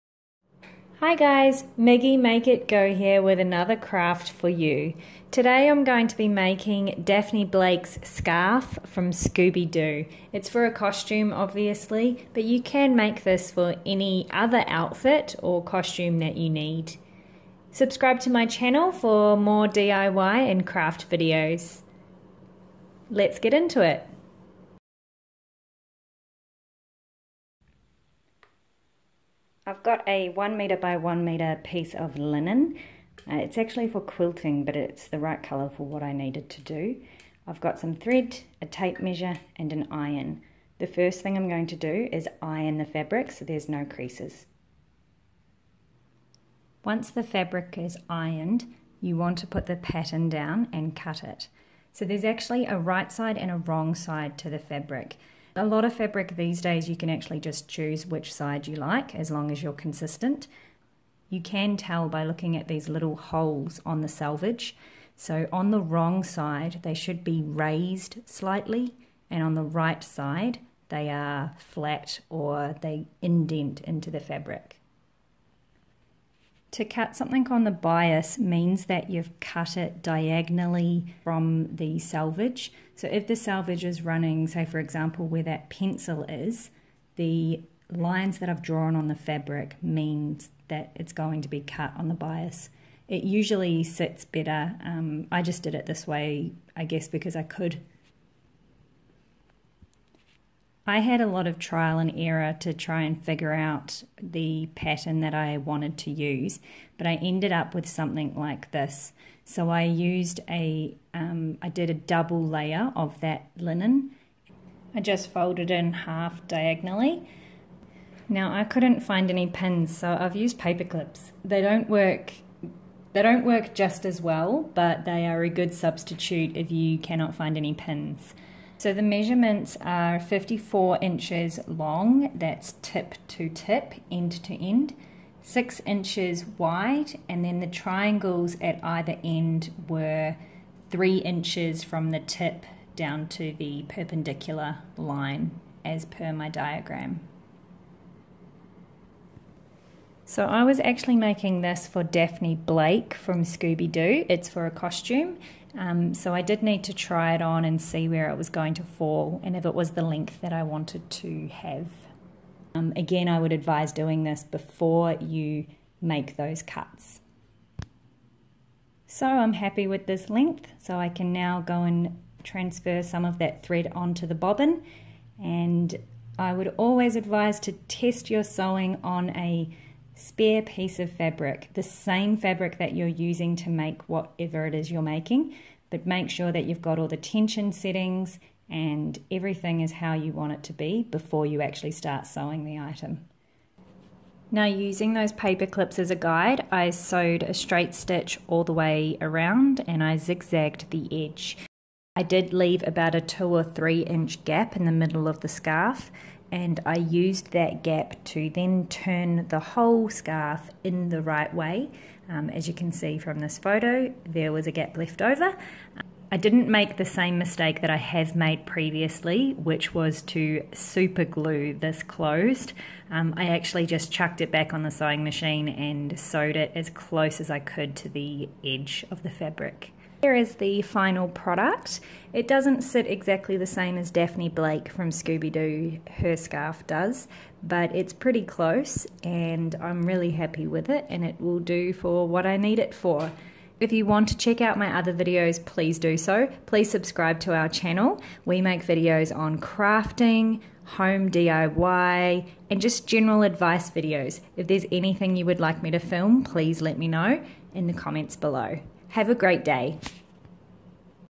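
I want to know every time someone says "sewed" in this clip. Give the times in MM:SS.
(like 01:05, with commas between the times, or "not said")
03:16, 03:46.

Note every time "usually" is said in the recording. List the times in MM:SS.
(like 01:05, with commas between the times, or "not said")
01:33.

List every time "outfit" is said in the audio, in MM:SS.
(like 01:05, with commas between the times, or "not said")
00:14.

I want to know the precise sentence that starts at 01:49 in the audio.
So I used a, um, I did a double layer of that linen.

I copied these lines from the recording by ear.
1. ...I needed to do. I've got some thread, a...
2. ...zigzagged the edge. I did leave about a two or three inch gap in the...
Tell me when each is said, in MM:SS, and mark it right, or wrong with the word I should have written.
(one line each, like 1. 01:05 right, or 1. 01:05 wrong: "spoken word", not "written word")
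1. 00:36 right
2. 03:20 right.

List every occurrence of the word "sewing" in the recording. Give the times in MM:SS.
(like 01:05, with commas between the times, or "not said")
02:58, 03:12, 03:44.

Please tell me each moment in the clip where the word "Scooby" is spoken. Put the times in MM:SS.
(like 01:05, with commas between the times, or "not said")
00:09, 02:33, 03:55.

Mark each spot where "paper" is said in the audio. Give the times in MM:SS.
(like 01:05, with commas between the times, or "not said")
02:00, 03:15.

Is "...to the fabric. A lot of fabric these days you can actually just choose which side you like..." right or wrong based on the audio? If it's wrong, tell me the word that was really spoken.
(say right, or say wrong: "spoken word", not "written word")
right.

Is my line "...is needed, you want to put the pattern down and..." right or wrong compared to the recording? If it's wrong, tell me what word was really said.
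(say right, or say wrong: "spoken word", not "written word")
wrong: "ironed", not "needed".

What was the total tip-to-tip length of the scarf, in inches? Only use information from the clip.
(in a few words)
54 inches.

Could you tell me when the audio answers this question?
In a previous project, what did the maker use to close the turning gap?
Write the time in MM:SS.
03:40.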